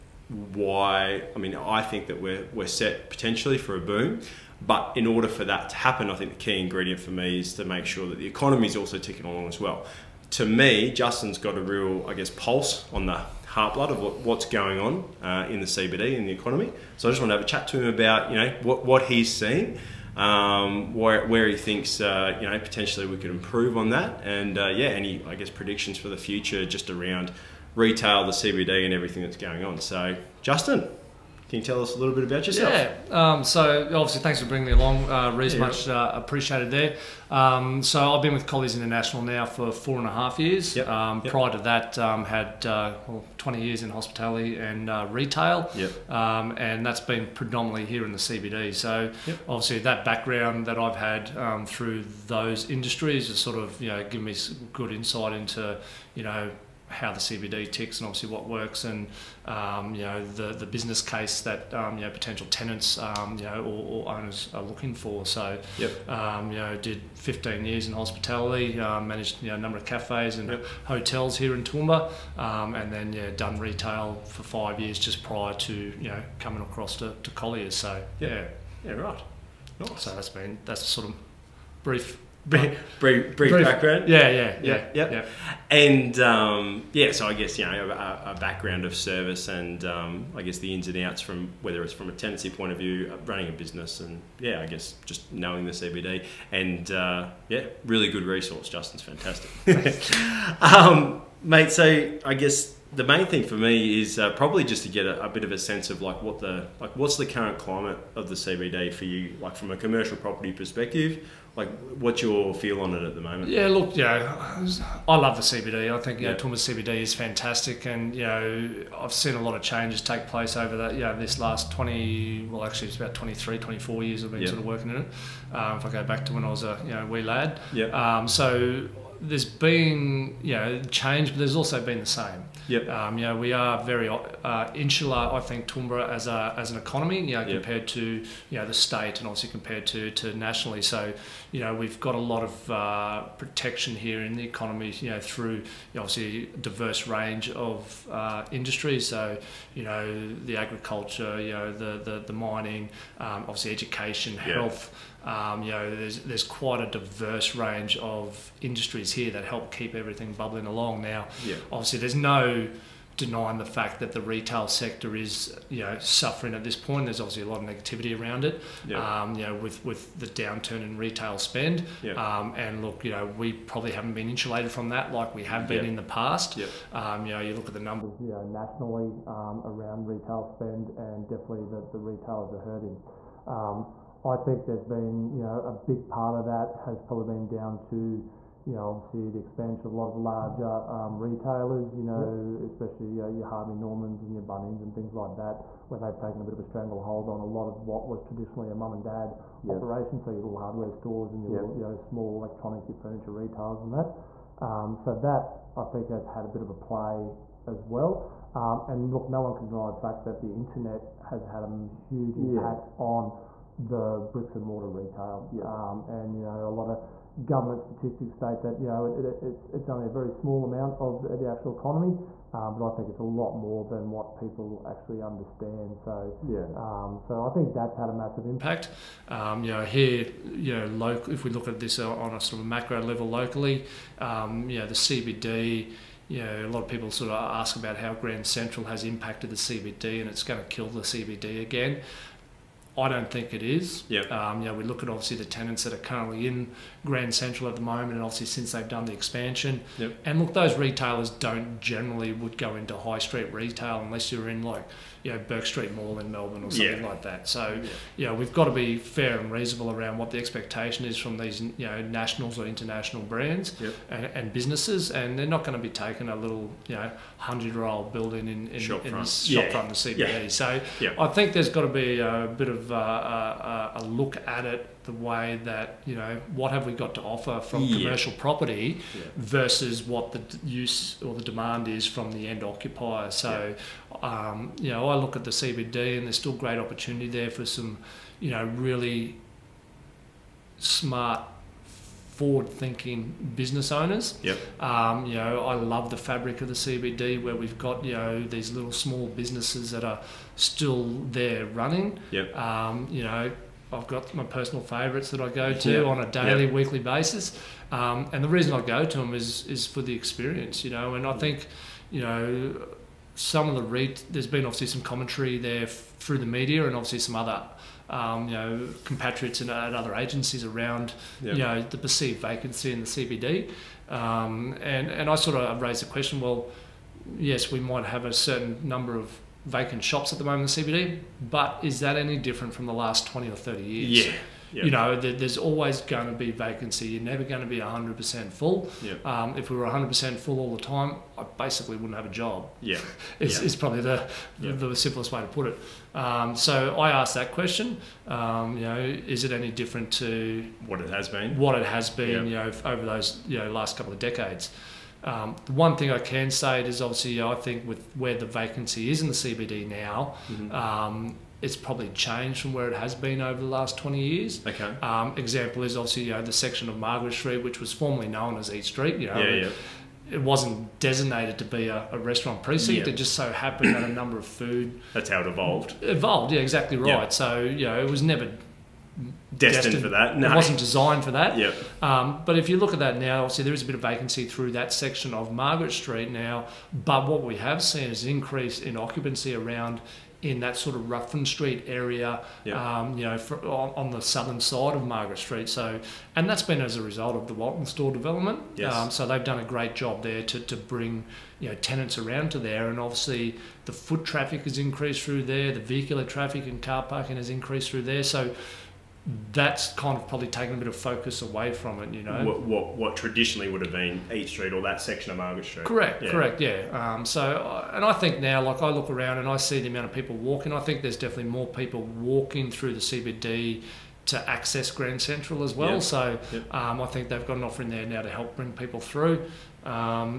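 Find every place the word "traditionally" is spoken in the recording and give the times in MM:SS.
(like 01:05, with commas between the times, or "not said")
03:18, 06:53.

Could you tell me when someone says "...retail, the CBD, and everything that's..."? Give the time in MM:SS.
00:27.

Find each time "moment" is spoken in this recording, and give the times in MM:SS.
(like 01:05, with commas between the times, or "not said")
01:53, 04:07, 05:30.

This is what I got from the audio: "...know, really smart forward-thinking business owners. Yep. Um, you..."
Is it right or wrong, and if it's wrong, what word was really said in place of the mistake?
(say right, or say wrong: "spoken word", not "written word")
right.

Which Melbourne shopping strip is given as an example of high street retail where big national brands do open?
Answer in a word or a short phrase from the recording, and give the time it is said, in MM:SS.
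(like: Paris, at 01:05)
Bourke Street Mall, at 04:15.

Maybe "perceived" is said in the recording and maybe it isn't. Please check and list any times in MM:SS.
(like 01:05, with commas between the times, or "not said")
05:21.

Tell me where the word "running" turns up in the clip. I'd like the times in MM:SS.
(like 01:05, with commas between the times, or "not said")
01:33, 05:01.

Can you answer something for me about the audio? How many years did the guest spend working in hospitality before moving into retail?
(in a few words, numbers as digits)
15.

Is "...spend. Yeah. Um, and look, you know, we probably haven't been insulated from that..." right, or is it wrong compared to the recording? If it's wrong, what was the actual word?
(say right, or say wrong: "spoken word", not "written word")
right.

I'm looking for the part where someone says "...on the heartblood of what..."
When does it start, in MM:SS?
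00:12.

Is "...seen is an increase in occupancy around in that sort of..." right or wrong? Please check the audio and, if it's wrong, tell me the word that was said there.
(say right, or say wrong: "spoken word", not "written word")
right.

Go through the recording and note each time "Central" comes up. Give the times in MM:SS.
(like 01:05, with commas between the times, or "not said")
03:58, 04:07, 07:05.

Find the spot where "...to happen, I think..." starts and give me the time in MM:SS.
00:05.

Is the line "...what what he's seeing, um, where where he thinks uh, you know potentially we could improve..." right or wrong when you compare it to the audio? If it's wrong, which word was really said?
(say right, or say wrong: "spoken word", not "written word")
right.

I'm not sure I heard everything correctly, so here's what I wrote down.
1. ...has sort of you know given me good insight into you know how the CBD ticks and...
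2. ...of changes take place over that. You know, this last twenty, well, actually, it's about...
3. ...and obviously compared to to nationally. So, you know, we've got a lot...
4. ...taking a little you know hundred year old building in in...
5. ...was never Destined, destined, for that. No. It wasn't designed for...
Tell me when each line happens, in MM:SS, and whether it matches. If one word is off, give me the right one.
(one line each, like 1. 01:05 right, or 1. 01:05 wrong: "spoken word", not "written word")
1. 00:53 right
2. 01:59 right
3. 02:19 right
4. 04:25 right
5. 06:18 right.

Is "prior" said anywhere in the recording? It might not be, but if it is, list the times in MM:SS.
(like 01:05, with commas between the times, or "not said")
00:41, 01:15.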